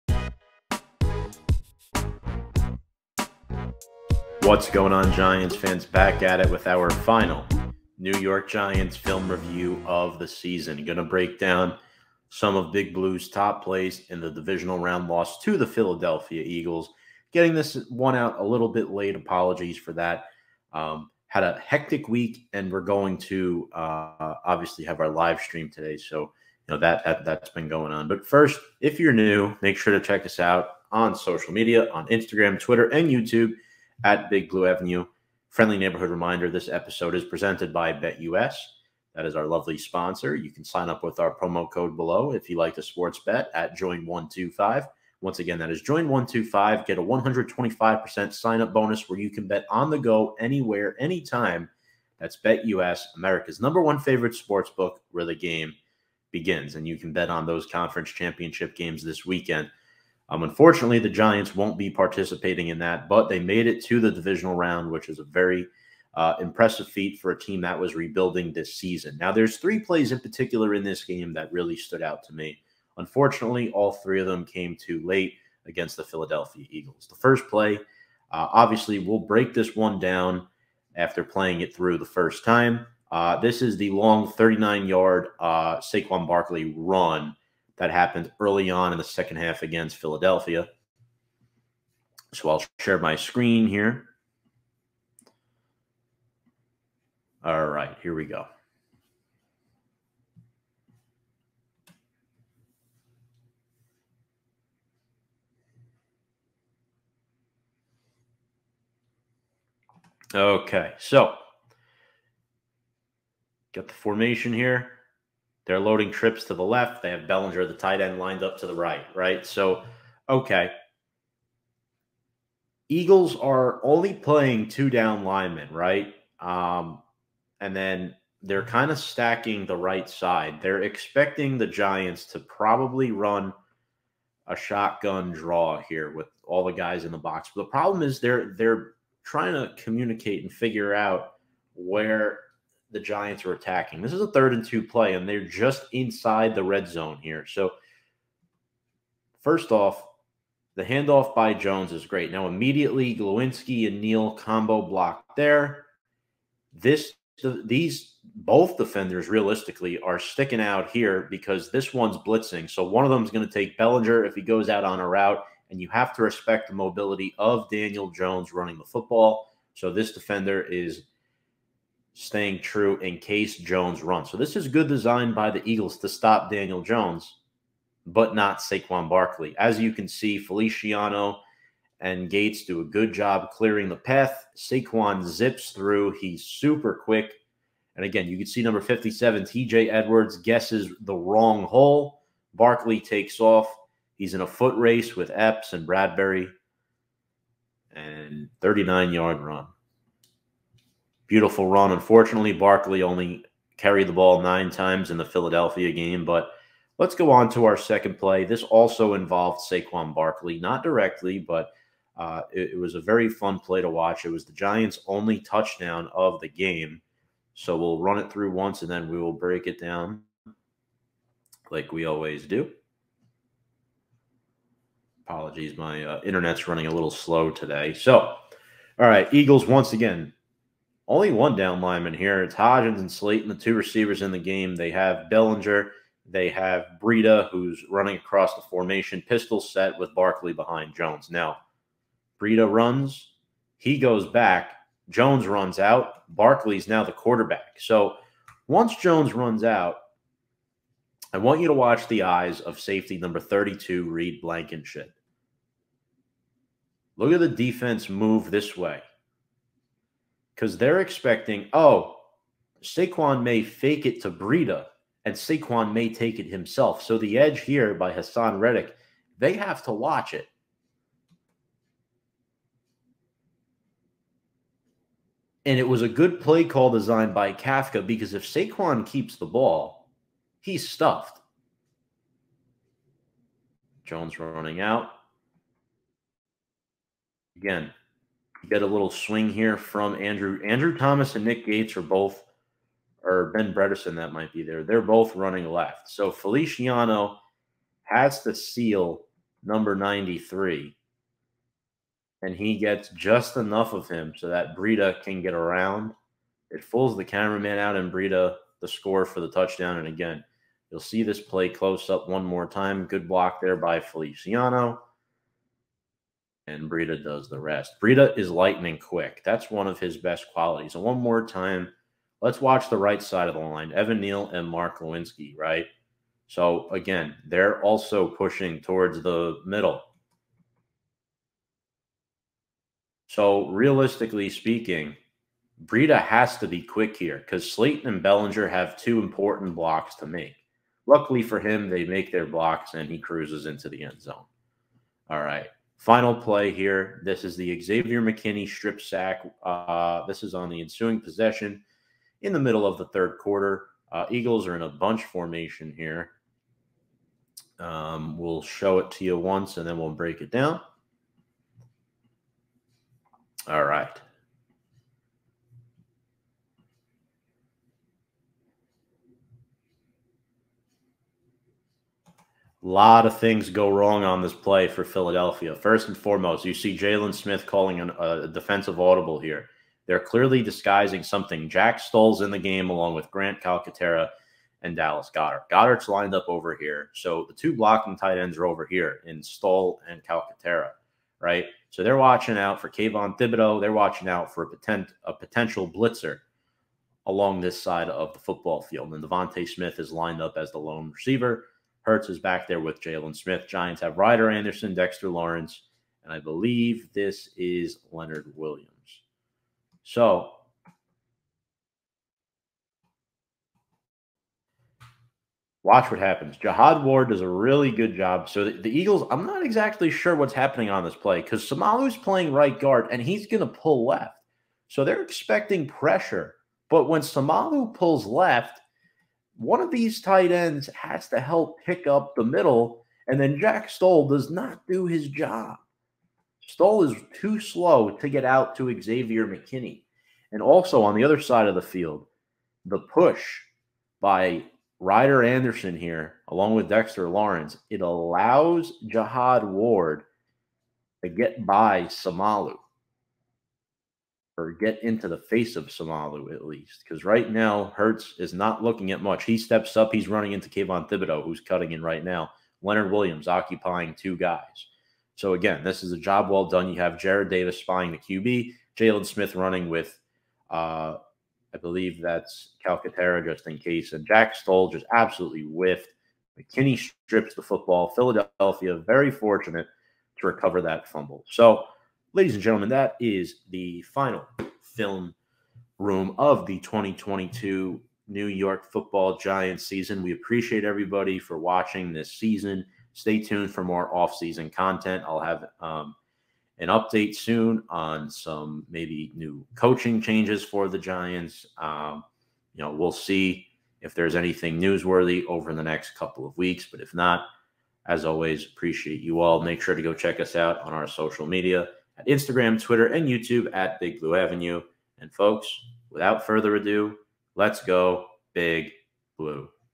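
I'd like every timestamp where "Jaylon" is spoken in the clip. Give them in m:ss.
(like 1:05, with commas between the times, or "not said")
6:16, 6:43, 7:48.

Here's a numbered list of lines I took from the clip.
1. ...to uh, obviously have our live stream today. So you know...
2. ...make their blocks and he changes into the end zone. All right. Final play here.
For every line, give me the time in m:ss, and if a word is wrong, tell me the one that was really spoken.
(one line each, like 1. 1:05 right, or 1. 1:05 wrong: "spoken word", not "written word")
1. 0:23 right
2. 5:42 wrong: "cruises", not "changes".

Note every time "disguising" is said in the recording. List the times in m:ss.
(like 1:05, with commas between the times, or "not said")
6:20.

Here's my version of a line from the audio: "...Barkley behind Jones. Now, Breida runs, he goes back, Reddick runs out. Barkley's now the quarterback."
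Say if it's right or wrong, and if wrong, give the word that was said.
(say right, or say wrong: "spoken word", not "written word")
wrong: "Jones", not "Reddick".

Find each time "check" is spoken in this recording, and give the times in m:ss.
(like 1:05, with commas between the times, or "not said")
0:30, 8:30.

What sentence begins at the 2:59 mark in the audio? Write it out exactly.
As you can see, Feliciano and Gates do a good job clearing the path.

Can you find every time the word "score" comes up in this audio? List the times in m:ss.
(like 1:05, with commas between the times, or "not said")
5:08.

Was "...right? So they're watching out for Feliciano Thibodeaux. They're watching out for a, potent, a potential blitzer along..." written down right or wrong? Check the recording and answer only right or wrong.
wrong.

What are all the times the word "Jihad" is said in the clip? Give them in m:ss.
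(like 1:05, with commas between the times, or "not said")
6:56, 7:29.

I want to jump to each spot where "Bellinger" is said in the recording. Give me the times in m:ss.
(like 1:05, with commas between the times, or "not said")
1:57, 2:43, 3:55, 5:38.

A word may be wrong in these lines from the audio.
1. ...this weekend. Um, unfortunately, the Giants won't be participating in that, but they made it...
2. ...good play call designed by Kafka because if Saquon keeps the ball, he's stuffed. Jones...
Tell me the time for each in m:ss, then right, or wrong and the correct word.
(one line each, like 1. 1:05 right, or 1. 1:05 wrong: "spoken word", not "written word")
1. 0:59 right
2. 4:36 right.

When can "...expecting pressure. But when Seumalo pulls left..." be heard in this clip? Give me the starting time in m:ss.
7:05.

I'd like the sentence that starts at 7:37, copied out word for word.
Because right now, Hurts is not looking at much.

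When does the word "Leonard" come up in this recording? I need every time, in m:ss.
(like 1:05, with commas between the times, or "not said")
6:48, 7:42.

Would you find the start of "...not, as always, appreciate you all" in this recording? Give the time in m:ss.
8:27.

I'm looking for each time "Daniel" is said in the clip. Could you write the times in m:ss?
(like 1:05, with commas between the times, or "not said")
2:47, 2:56.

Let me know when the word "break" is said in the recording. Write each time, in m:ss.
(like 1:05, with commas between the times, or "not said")
0:11, 1:19, 3:39, 6:00.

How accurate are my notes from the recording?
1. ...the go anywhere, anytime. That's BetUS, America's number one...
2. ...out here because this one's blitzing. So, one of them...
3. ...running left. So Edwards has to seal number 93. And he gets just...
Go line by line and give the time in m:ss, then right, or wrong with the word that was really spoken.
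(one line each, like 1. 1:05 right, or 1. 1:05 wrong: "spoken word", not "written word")
1. 0:49 right
2. 2:40 right
3. 4:55 wrong: "Feliciano", not "Edwards".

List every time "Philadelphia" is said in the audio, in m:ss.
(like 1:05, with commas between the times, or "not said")
0:15, 1:16, 1:29, 3:25, 6:15, 7:58.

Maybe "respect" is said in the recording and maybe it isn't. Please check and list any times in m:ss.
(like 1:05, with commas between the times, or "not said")
2:46.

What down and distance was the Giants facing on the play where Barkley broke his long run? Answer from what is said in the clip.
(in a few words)
third and two.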